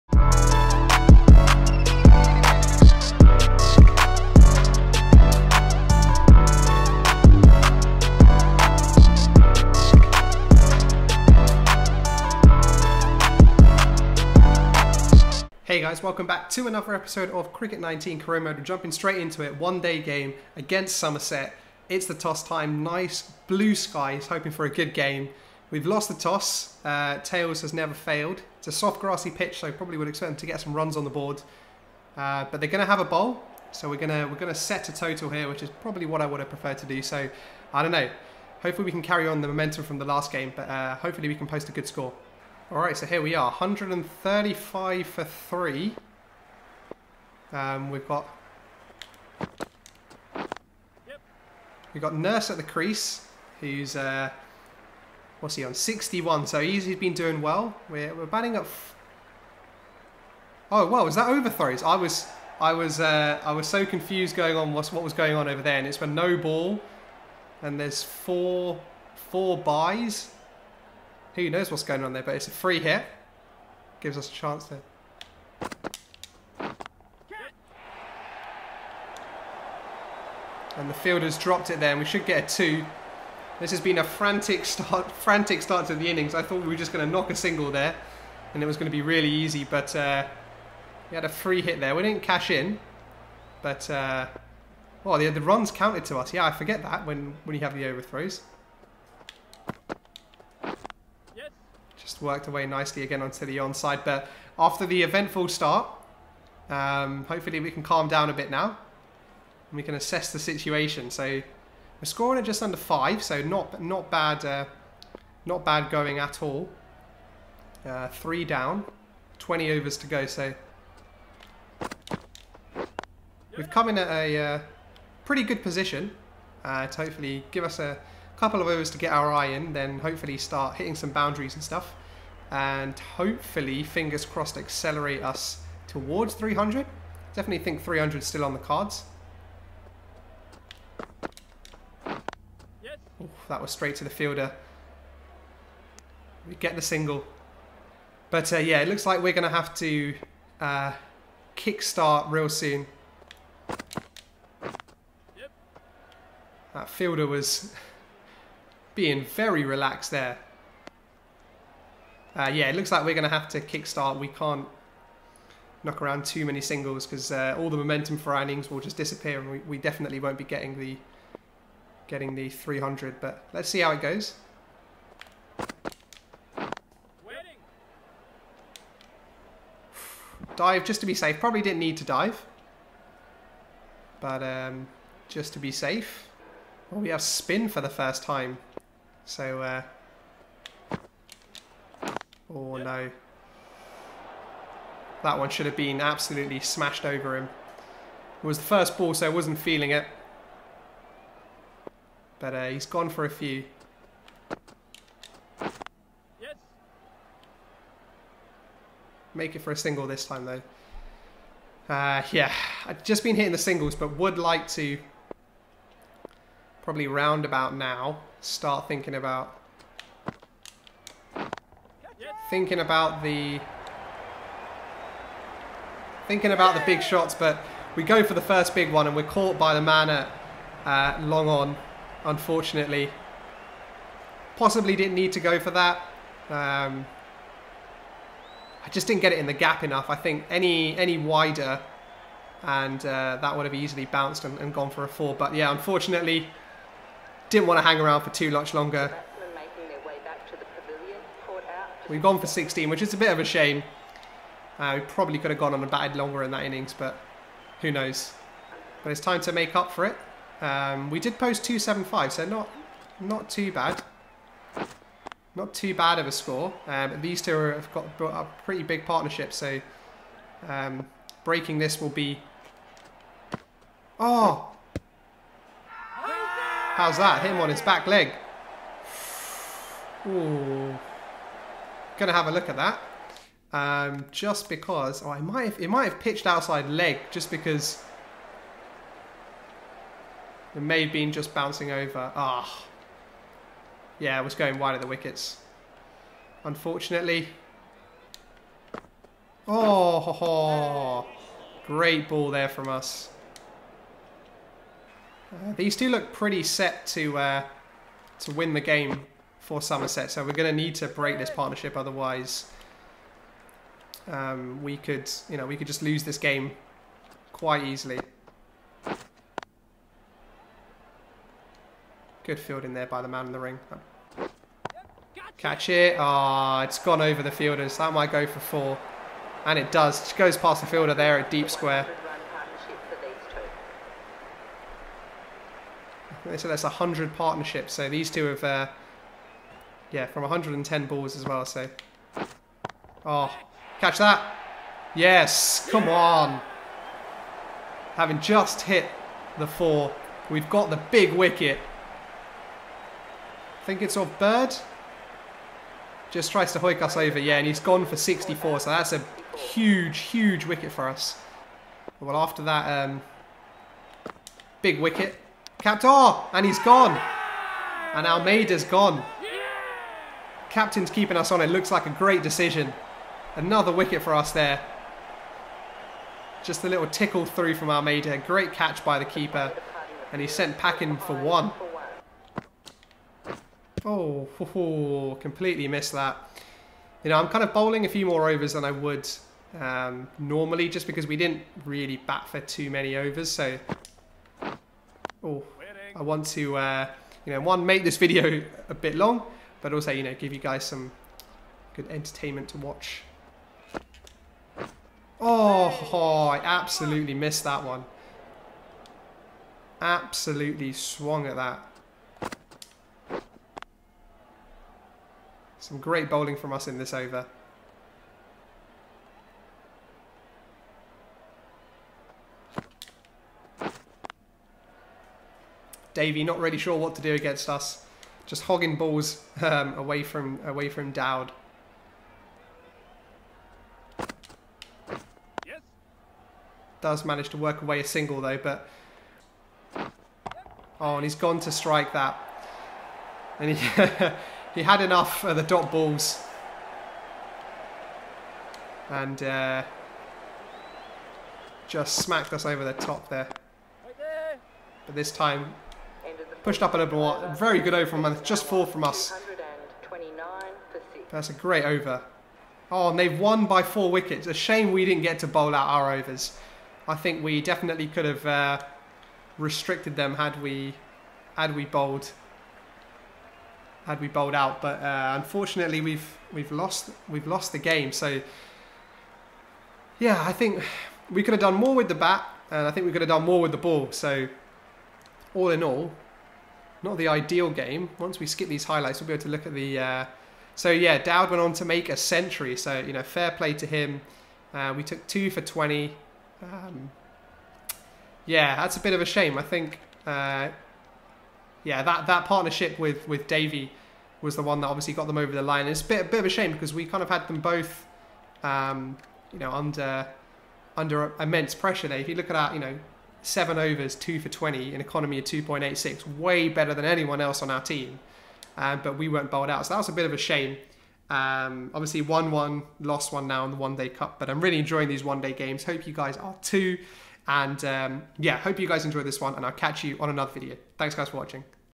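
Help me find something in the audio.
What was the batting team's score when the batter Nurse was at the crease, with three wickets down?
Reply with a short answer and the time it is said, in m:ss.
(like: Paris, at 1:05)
135 for 3, at 0:43.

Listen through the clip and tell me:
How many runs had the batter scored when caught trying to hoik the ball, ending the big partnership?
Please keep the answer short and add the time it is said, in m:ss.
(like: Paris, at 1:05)
64, at 5:58.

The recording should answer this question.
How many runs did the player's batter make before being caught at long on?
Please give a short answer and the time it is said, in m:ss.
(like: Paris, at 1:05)
16, at 4:12.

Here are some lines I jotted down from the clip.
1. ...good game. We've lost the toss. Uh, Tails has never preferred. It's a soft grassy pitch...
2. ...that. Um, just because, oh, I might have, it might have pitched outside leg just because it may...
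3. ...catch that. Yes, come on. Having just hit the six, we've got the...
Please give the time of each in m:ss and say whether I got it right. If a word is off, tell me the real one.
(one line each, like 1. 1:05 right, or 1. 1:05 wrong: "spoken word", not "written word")
1. 0:24 wrong: "failed", not "preferred"
2. 4:42 right
3. 5:43 wrong: "four", not "six".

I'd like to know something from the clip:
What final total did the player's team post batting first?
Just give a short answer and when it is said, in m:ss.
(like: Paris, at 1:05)
275, at 4:21.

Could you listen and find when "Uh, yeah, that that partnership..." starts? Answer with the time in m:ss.
8:20.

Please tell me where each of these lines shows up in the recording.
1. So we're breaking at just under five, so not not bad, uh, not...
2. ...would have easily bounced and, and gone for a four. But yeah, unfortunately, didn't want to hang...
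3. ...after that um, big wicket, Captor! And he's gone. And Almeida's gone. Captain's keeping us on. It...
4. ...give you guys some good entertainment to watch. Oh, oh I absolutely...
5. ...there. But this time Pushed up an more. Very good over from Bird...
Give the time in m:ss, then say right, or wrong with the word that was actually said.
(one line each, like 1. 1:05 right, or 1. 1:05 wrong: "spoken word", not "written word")
1. 1:51 wrong: "scoring", not "breaking"
2. 4:03 right
3. 6:02 right
4. 6:40 right
5. 7:33 wrong: "Just", not "Bird".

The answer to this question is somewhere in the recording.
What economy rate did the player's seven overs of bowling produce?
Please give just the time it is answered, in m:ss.
8:35.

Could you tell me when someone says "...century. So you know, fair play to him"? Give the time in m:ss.
8:12.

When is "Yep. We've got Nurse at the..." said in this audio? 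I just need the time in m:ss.
0:50.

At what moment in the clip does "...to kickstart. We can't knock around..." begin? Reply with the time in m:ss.
2:43.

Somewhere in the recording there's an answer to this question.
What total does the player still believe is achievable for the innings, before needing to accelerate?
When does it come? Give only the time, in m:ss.
2:17.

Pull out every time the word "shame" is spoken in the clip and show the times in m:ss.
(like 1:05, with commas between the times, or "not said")
4:13, 7:44, 8:19, 8:26, 8:40.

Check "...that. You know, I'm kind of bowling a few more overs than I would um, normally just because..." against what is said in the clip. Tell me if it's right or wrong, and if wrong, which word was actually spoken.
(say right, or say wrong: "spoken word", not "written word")
right.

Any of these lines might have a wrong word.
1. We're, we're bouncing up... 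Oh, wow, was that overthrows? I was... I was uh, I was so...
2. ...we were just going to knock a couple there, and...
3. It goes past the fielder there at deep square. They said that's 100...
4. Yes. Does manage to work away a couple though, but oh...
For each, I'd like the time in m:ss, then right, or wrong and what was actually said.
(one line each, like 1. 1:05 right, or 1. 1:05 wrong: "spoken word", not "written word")
1. 0:57 wrong: "batting", not "bouncing"
2. 1:26 wrong: "single", not "couple"
3. 5:30 right
4. 7:15 wrong: "single", not "couple".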